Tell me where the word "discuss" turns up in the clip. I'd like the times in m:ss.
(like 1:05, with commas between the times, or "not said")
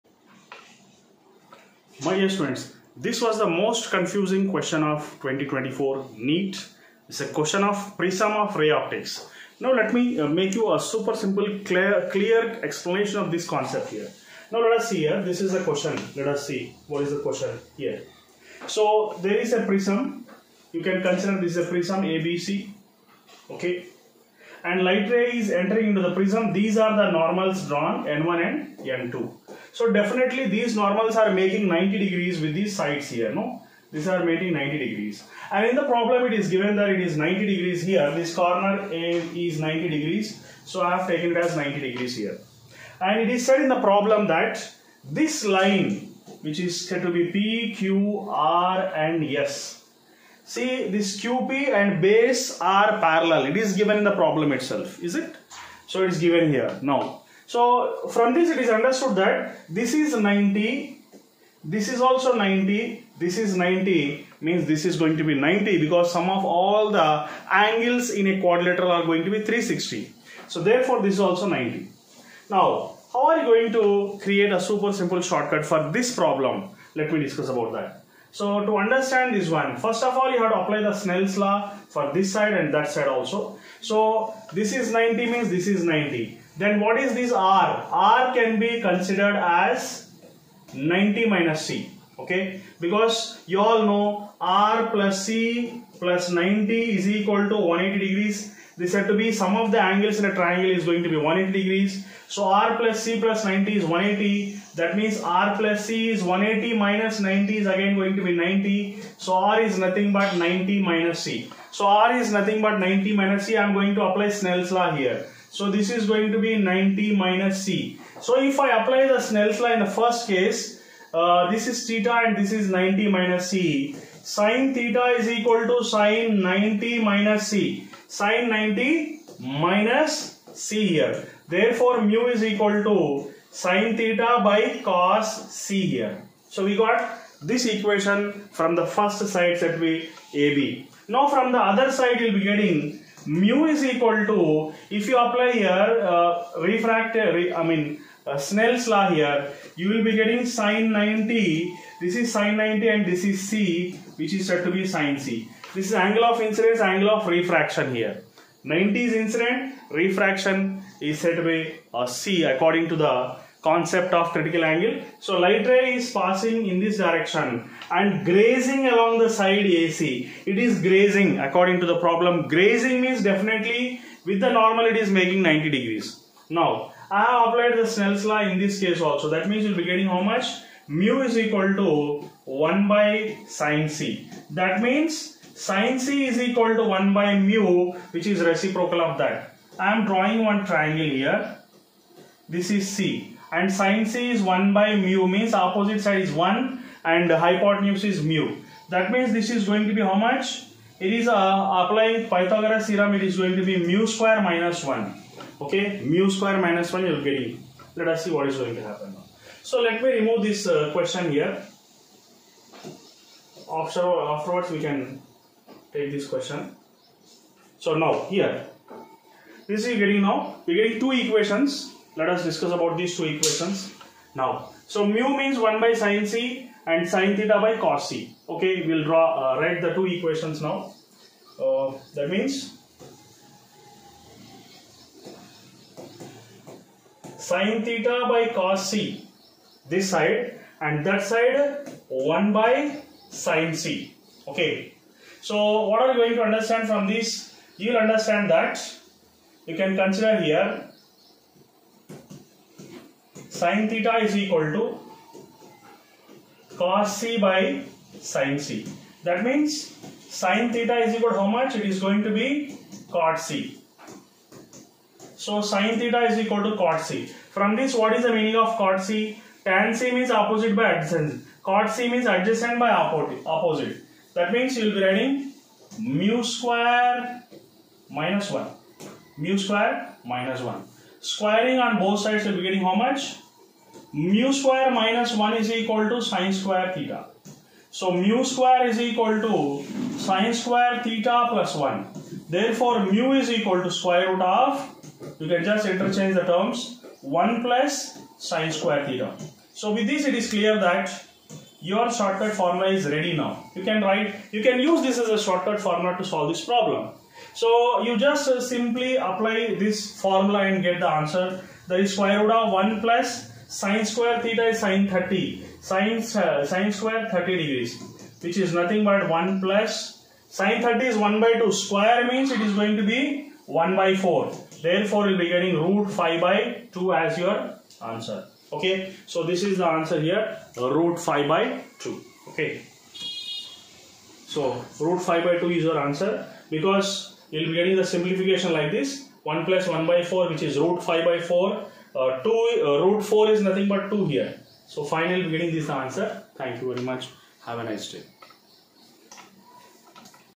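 1:17, 3:42.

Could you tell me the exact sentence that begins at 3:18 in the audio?
That means this is going to be how much?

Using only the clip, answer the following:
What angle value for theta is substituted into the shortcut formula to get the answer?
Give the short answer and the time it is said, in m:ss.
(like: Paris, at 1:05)
30 degrees, at 5:17.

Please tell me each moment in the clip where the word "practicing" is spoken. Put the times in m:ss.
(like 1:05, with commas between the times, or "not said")
not said.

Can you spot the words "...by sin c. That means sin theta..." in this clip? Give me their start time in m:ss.
4:17.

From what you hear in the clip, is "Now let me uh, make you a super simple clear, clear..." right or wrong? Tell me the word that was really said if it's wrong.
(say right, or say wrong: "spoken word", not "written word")
right.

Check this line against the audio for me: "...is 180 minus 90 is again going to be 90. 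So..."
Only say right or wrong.
right.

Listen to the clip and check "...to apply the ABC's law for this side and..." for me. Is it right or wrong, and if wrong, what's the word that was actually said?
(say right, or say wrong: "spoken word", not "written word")
wrong: "Snell", not "ABC".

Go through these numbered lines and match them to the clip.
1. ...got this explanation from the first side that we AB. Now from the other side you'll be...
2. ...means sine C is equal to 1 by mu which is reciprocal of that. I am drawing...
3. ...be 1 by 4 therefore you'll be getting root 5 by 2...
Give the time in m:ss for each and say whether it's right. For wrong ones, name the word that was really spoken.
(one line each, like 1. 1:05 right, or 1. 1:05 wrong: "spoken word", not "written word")
1. 2:16 wrong: "equation", not "explanation"
2. 3:04 right
3. 5:23 right.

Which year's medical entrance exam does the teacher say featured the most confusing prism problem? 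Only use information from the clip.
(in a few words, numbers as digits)
2024.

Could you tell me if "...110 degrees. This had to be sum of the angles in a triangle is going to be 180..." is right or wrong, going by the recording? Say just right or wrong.
wrong.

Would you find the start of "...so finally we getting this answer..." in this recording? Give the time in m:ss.
5:44.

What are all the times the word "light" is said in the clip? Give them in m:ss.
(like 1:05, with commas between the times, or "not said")
0:24, 2:45.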